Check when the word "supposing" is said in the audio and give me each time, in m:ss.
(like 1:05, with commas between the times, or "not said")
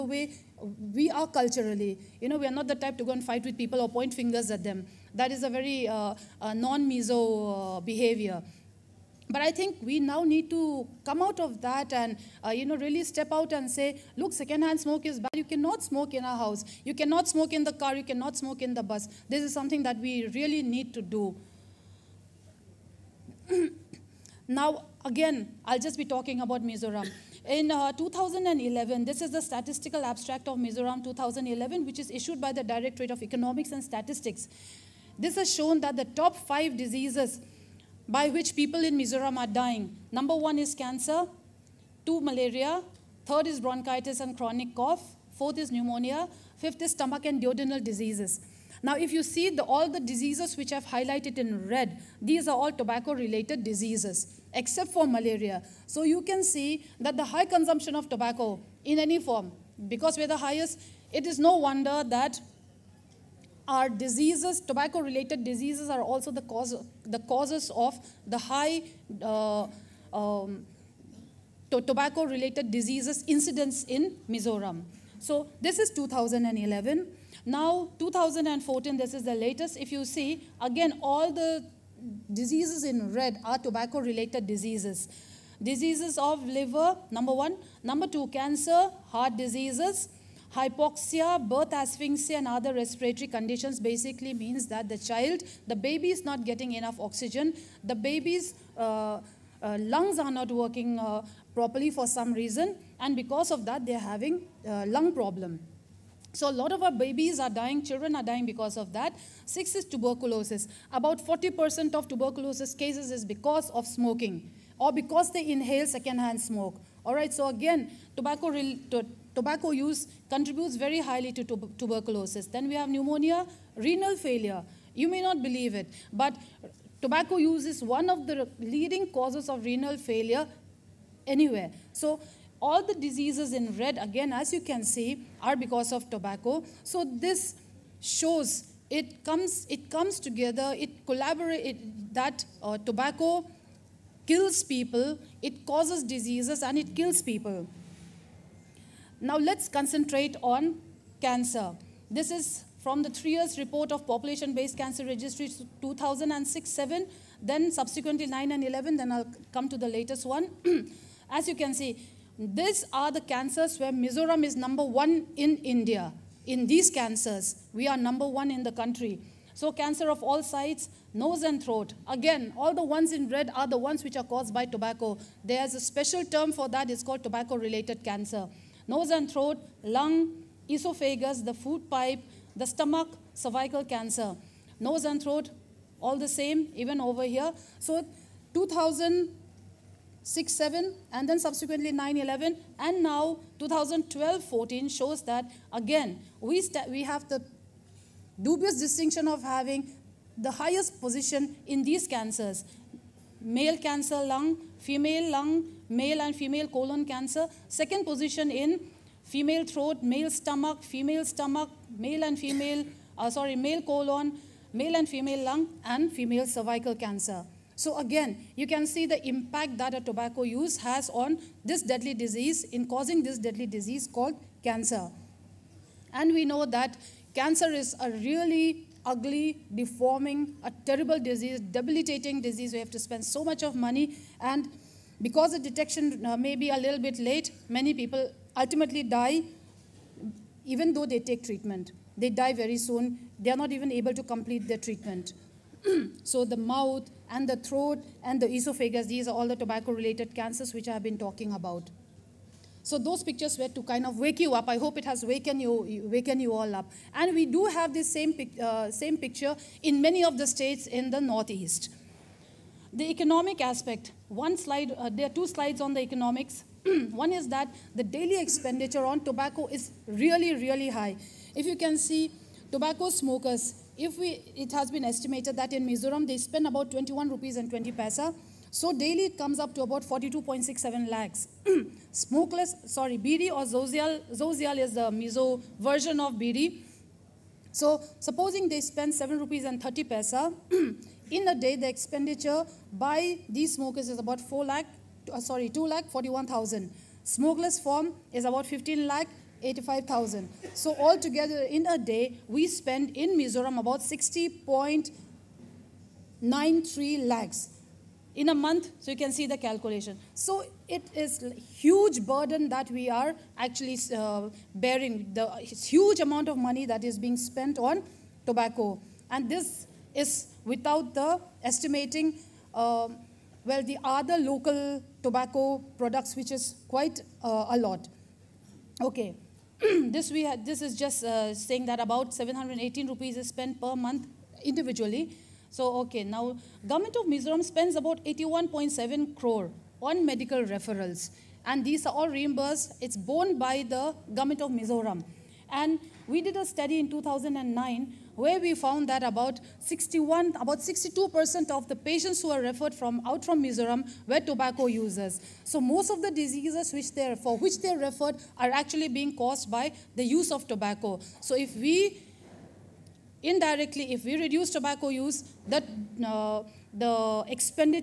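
4:48.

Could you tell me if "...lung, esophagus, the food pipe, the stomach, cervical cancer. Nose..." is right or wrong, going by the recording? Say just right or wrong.
right.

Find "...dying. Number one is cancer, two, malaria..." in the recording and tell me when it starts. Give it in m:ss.
0:39.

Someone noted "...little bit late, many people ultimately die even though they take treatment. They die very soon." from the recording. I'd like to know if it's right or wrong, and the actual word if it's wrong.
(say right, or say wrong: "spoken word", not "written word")
right.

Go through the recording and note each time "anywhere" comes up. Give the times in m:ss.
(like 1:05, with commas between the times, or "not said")
2:11.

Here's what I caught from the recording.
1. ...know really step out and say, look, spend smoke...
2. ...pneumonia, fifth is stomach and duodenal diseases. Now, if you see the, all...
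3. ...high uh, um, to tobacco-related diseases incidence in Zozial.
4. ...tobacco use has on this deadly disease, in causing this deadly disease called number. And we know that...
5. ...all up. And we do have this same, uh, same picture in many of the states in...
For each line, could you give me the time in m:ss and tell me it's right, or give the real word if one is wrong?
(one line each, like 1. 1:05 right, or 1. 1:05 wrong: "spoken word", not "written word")
1. 0:12 wrong: "secondhand", not "spend"
2. 0:45 right
3. 1:08 wrong: "Mizoram", not "Zozial"
4. 3:40 wrong: "cancer", not "number"
5. 4:16 right.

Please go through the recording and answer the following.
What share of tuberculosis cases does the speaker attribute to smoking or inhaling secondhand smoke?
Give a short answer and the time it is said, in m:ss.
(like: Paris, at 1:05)
40%, at 1:50.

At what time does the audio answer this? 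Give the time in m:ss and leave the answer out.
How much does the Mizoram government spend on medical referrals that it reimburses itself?
5:38.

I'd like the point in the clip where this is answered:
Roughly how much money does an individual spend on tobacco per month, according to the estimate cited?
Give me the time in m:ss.
5:32.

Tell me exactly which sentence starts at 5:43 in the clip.
It's borne by the government of Mizoram.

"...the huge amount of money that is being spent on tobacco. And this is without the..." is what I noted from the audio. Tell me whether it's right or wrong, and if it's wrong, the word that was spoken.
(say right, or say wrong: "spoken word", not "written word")
right.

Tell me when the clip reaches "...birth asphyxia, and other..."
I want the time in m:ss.
1:31.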